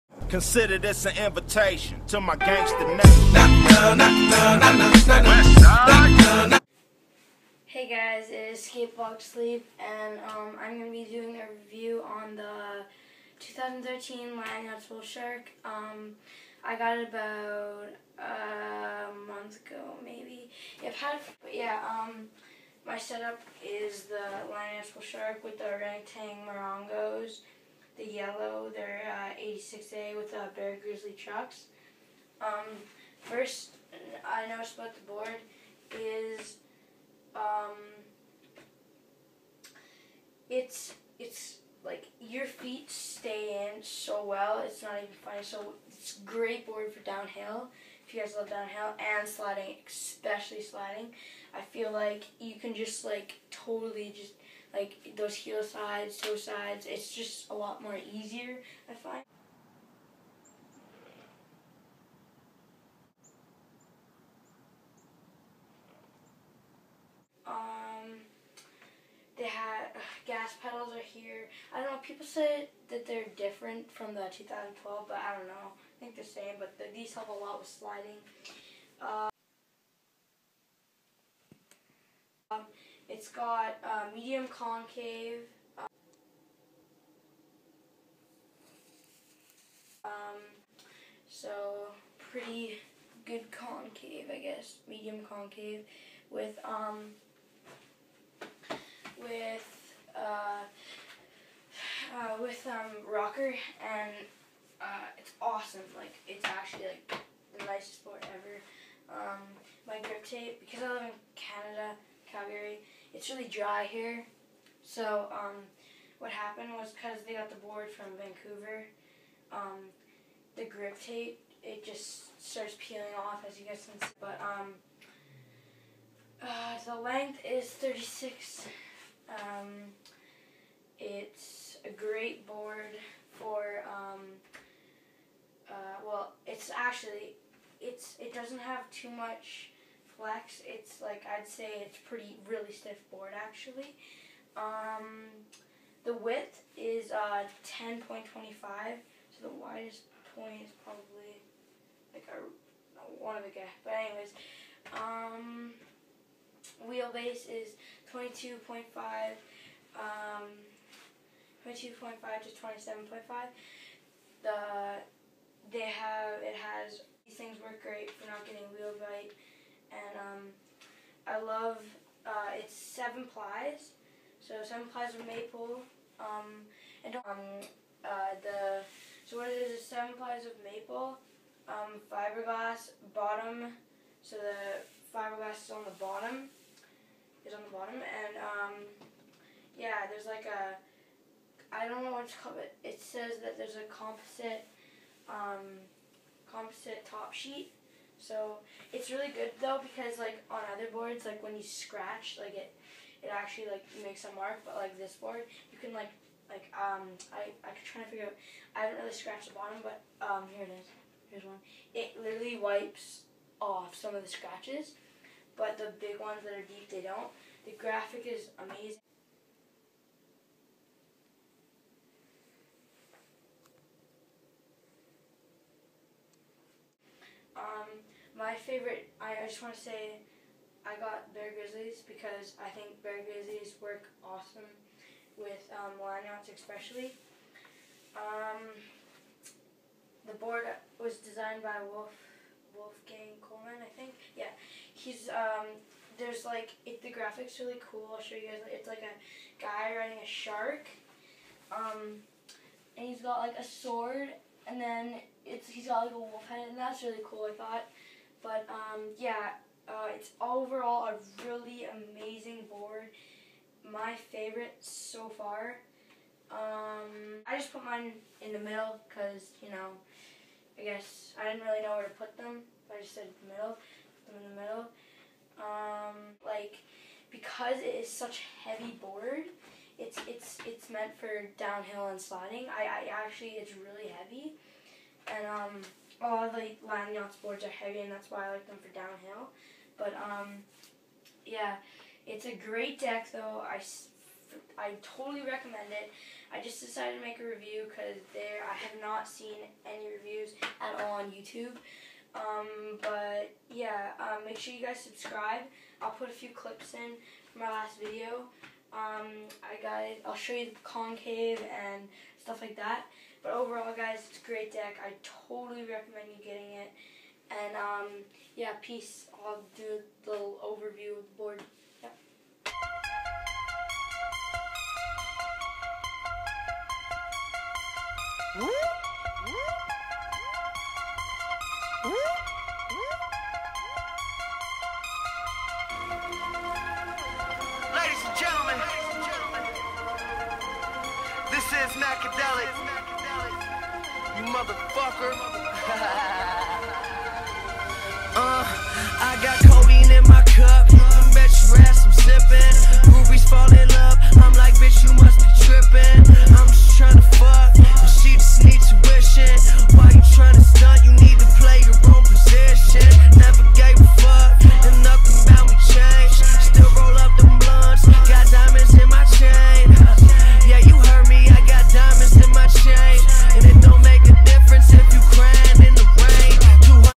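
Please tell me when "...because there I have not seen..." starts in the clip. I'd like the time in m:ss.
4:57.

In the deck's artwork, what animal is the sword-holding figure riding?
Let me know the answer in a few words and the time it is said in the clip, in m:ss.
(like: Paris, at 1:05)
shark, at 4:09.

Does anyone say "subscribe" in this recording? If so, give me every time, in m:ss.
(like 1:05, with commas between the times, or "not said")
5:04.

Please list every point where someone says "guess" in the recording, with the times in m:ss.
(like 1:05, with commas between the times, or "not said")
1:34, 4:30.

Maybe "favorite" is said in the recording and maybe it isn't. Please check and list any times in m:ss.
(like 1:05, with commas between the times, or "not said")
3:48, 4:24.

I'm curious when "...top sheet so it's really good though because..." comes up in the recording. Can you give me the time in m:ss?
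3:17.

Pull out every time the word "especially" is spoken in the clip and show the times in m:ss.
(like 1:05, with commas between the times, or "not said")
0:49, 3:56.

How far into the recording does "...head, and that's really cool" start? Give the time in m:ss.
4:16.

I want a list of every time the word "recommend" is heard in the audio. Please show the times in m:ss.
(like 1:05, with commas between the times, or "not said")
4:55, 5:15.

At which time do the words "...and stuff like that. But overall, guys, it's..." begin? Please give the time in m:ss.
5:11.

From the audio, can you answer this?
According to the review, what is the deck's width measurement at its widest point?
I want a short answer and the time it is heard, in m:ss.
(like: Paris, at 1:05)
10.25, at 2:27.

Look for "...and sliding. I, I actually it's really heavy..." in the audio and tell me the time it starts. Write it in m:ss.
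4:42.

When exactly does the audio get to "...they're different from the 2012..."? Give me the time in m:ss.
1:13.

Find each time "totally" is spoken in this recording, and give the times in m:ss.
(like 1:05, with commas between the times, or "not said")
0:53, 4:55, 5:15.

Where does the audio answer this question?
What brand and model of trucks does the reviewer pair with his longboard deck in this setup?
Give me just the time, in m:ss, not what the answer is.
0:30.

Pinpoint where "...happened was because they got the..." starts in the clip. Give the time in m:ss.
1:56.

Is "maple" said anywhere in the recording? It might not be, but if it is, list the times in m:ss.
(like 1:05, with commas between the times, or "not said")
2:55, 3:00.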